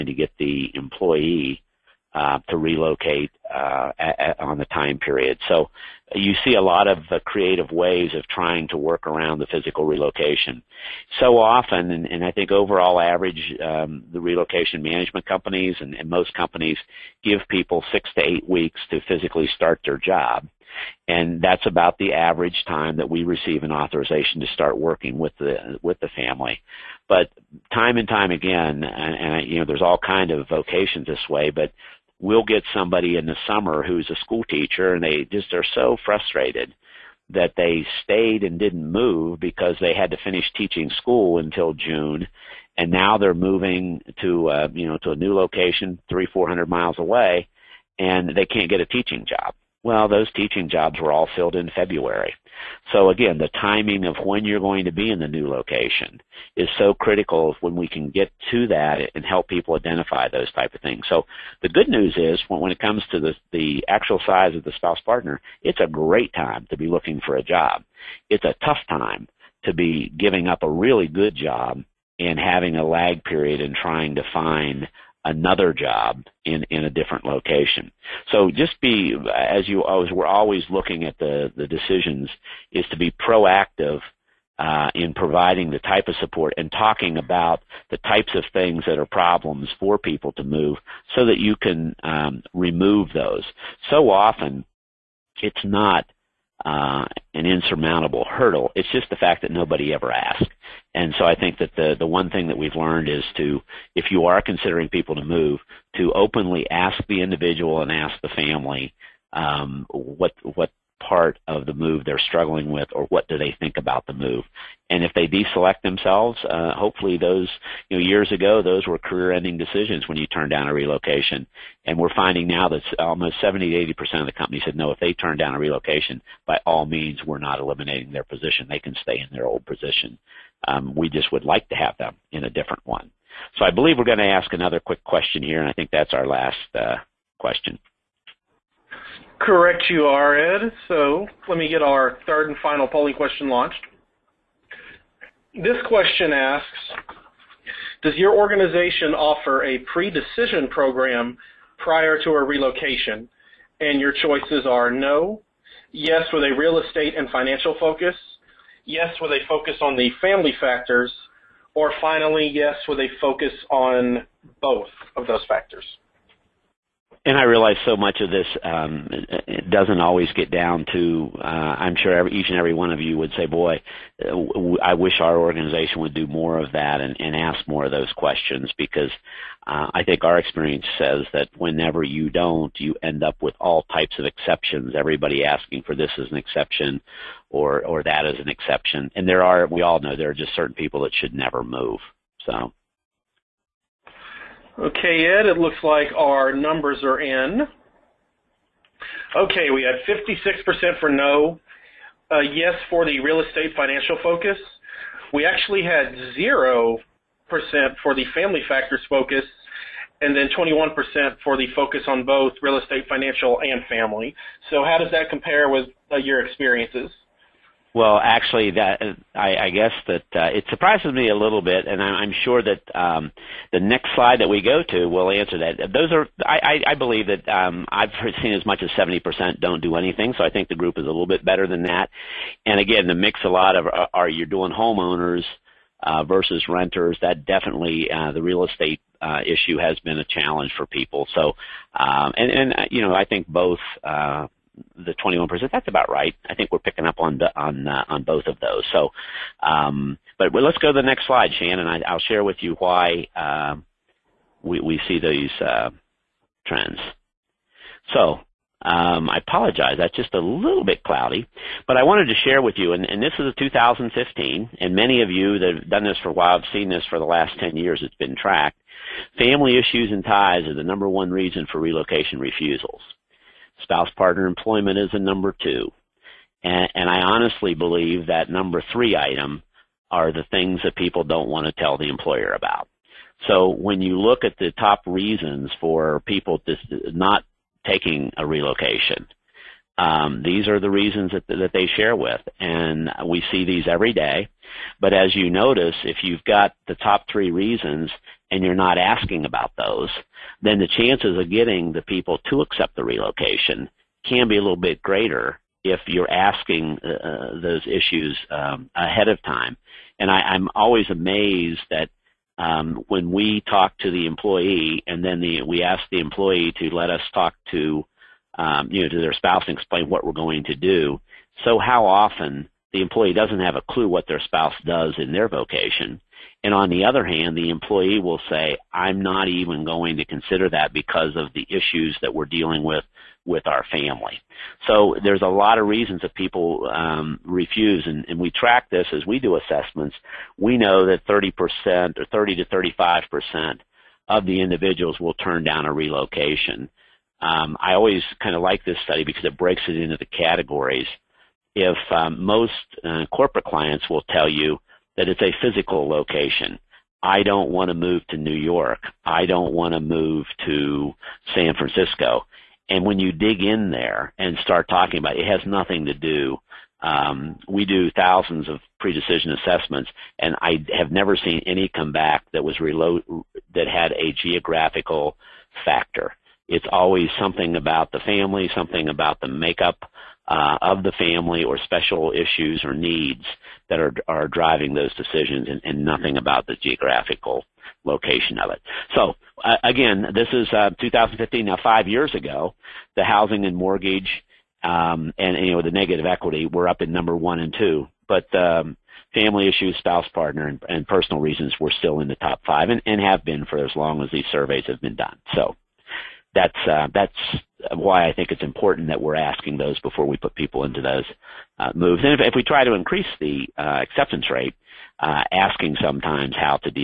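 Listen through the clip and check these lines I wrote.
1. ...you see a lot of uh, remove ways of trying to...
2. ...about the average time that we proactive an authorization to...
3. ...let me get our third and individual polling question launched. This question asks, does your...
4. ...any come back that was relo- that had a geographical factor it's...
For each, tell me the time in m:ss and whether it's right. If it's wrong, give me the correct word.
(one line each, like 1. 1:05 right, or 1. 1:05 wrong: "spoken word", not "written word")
1. 0:06 wrong: "creative", not "remove"
2. 0:21 wrong: "receive", not "proactive"
3. 2:21 wrong: "final", not "individual"
4. 6:11 right.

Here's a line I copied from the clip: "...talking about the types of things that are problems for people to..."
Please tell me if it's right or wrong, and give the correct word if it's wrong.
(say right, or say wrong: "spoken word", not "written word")
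right.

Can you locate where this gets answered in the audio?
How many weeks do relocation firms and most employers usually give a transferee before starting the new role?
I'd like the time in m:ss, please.
0:17.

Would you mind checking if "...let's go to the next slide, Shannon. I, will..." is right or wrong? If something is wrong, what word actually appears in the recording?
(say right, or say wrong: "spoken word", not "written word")
right.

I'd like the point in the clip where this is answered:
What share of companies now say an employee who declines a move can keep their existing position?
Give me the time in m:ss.
2:03.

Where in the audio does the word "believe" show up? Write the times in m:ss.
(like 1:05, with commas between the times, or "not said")
2:13, 3:46, 4:37.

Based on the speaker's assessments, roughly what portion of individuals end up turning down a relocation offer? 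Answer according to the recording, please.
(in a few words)
30 to 35%.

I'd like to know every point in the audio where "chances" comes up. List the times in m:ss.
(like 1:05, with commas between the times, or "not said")
5:00.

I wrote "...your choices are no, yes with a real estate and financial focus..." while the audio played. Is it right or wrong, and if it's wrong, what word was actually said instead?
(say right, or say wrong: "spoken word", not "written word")
right.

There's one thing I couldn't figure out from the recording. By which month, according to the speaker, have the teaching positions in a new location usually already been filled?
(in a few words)
February.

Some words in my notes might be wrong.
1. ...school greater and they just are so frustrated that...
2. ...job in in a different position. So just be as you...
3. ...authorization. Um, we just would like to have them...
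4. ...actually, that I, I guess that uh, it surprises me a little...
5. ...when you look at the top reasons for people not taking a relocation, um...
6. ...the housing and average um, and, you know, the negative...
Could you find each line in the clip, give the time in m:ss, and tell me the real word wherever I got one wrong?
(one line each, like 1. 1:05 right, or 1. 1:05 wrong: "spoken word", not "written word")
1. 0:34 wrong: "teacher", not "greater"
2. 1:15 wrong: "location", not "position"
3. 2:09 wrong: "position", not "authorization"
4. 3:38 right
5. 4:43 right
6. 6:33 wrong: "mortgage", not "average".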